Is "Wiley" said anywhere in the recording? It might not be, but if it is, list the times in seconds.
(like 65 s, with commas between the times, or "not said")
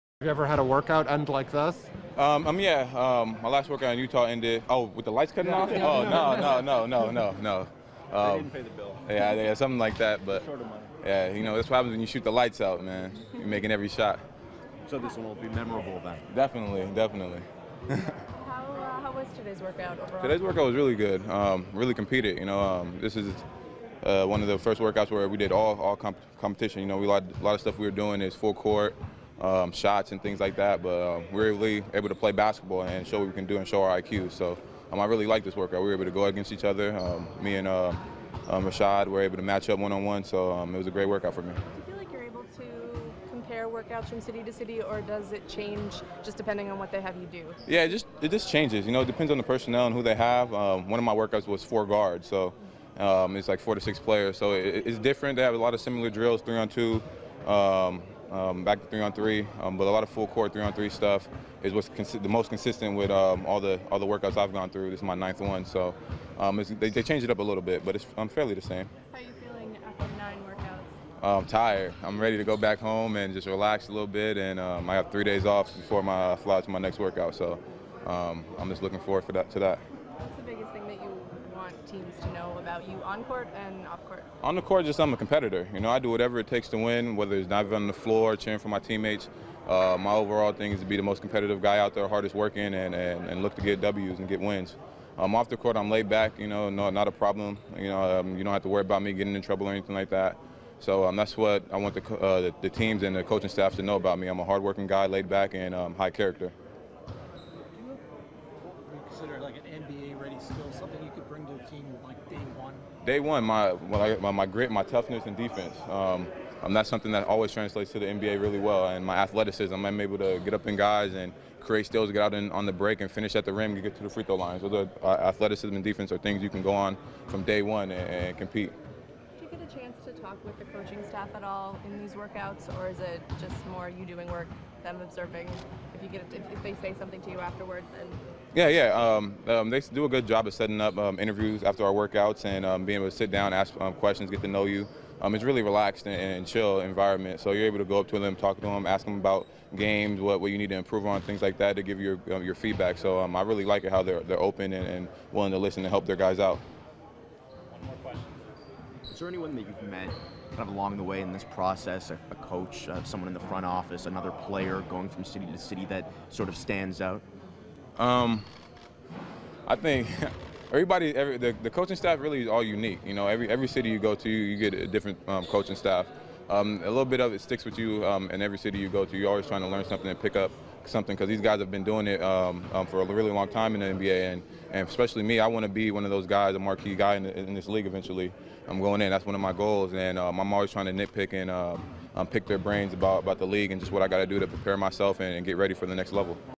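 not said.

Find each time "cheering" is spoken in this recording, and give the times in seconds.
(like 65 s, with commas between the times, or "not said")
88 s.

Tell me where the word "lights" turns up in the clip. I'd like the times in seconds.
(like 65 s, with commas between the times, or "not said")
5 s, 12 s.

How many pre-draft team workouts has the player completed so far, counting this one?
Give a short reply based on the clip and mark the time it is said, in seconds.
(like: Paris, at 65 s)
9, at 65 s.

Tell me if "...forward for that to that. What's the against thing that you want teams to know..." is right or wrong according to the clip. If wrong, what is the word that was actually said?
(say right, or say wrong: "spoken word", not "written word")
wrong: "biggest", not "against".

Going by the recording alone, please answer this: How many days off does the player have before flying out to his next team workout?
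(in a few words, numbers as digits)
3.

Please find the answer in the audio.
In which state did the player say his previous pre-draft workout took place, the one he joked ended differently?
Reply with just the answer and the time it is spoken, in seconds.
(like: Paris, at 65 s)
Utah, at 3 s.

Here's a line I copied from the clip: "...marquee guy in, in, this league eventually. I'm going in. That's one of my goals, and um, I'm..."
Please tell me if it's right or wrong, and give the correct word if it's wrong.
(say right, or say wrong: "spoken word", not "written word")
right.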